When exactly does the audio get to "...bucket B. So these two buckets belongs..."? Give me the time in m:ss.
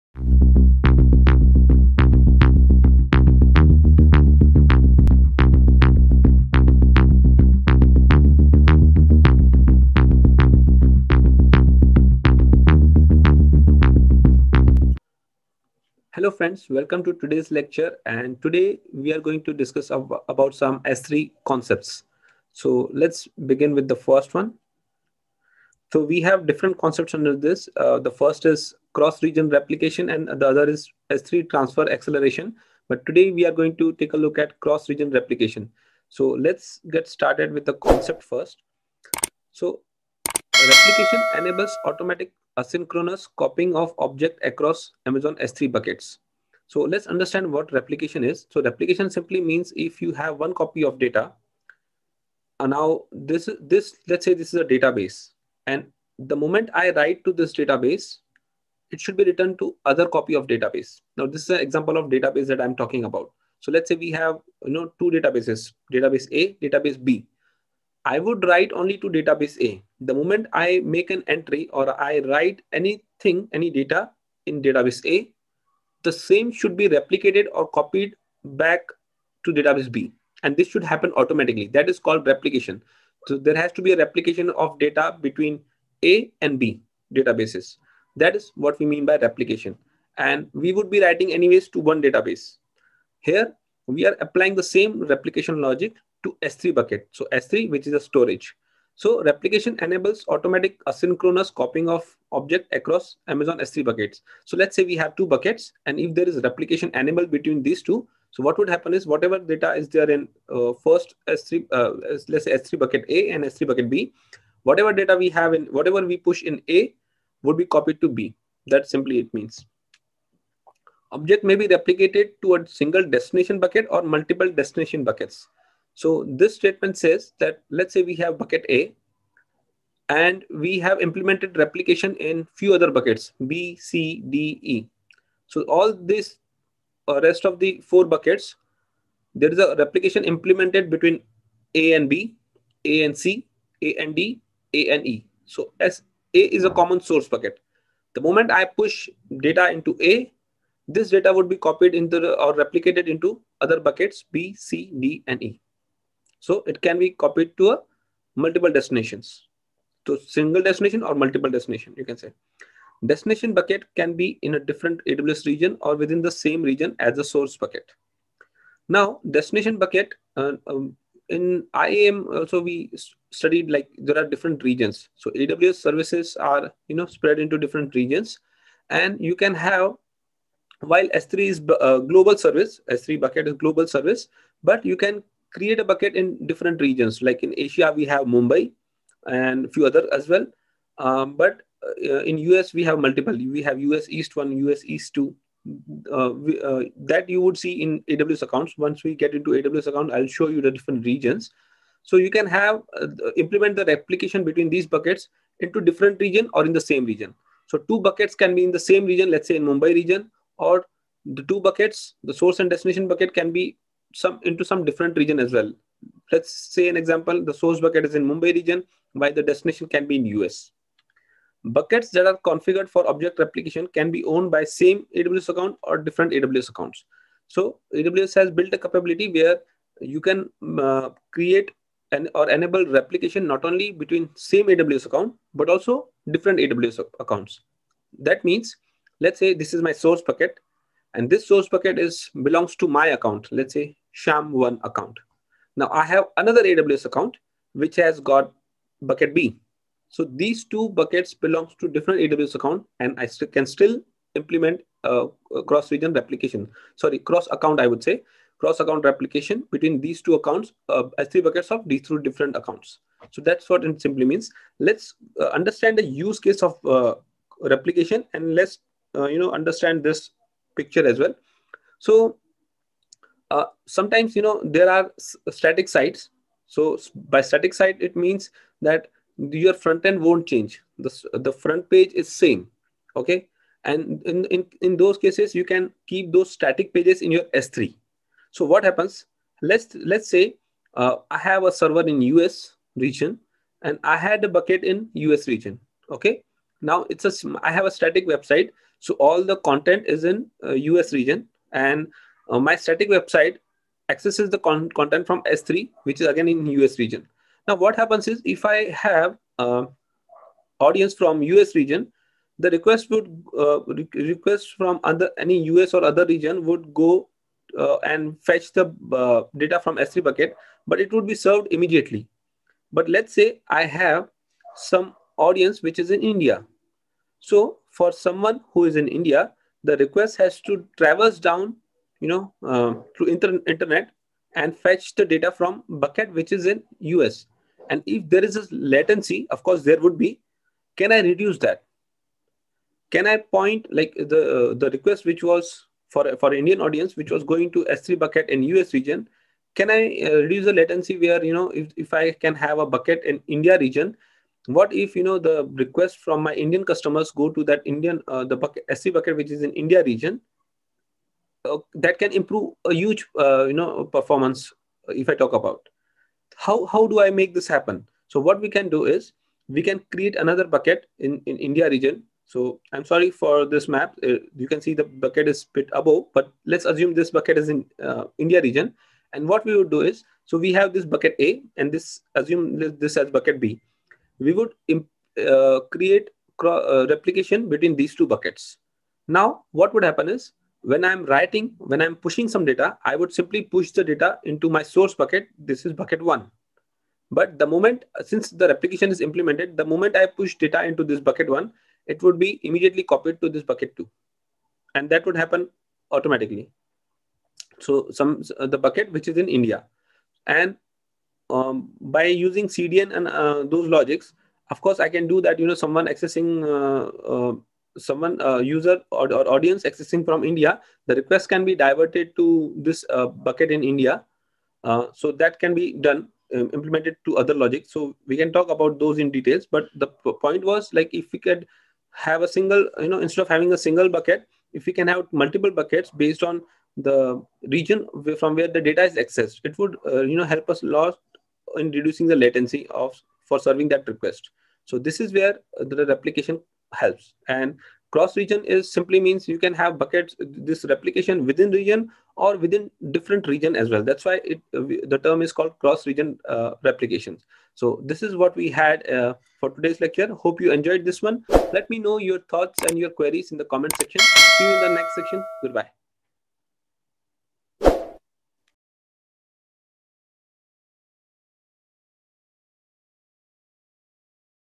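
4:09.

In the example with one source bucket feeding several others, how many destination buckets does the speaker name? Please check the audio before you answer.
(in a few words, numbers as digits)
4.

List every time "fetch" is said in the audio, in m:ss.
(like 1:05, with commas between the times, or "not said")
5:18, 5:34.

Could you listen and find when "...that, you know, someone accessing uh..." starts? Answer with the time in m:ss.
6:55.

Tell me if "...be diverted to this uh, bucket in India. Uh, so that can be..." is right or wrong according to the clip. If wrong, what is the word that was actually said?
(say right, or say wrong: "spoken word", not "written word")
right.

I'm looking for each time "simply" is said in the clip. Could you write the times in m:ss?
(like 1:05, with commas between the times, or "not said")
0:49, 1:58, 4:24, 6:33, 7:28.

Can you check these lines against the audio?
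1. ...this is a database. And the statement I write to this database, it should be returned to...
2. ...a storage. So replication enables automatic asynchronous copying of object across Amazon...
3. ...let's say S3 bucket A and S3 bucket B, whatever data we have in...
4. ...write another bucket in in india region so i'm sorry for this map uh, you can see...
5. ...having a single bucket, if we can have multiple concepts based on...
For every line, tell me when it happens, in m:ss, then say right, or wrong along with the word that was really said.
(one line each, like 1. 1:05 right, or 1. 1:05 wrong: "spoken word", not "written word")
1. 0:54 wrong: "moment", not "statement"
2. 1:37 right
3. 1:52 right
4. 6:10 wrong: "create", not "write"
5. 7:13 wrong: "buckets", not "concepts".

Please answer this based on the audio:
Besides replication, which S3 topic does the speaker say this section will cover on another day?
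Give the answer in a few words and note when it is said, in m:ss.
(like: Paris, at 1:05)
S3 transfer acceleration, at 0:31.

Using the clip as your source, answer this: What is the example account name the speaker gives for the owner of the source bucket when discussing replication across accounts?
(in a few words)
shyam1.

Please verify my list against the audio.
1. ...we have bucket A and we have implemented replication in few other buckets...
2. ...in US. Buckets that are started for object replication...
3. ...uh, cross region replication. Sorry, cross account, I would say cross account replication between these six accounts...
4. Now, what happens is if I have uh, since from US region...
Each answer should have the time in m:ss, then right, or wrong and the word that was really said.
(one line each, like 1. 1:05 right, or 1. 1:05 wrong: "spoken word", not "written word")
1. 2:08 right
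2. 3:40 wrong: "configured", not "started"
3. 4:15 wrong: "two", not "six"
4. 5:07 wrong: "audience", not "since".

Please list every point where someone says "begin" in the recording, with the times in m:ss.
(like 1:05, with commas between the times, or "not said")
0:23.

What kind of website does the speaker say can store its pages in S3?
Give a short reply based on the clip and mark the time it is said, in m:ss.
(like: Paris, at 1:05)
Static site, at 4:37.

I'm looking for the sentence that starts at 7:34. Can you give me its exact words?
That's why it, the term is called cross region uh, replications.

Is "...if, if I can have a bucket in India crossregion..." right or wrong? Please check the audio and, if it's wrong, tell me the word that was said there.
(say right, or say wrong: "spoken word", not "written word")
wrong: "region", not "crossregion".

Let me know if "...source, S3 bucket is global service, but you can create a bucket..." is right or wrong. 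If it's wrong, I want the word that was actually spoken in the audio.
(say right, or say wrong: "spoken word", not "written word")
wrong: "service", not "source".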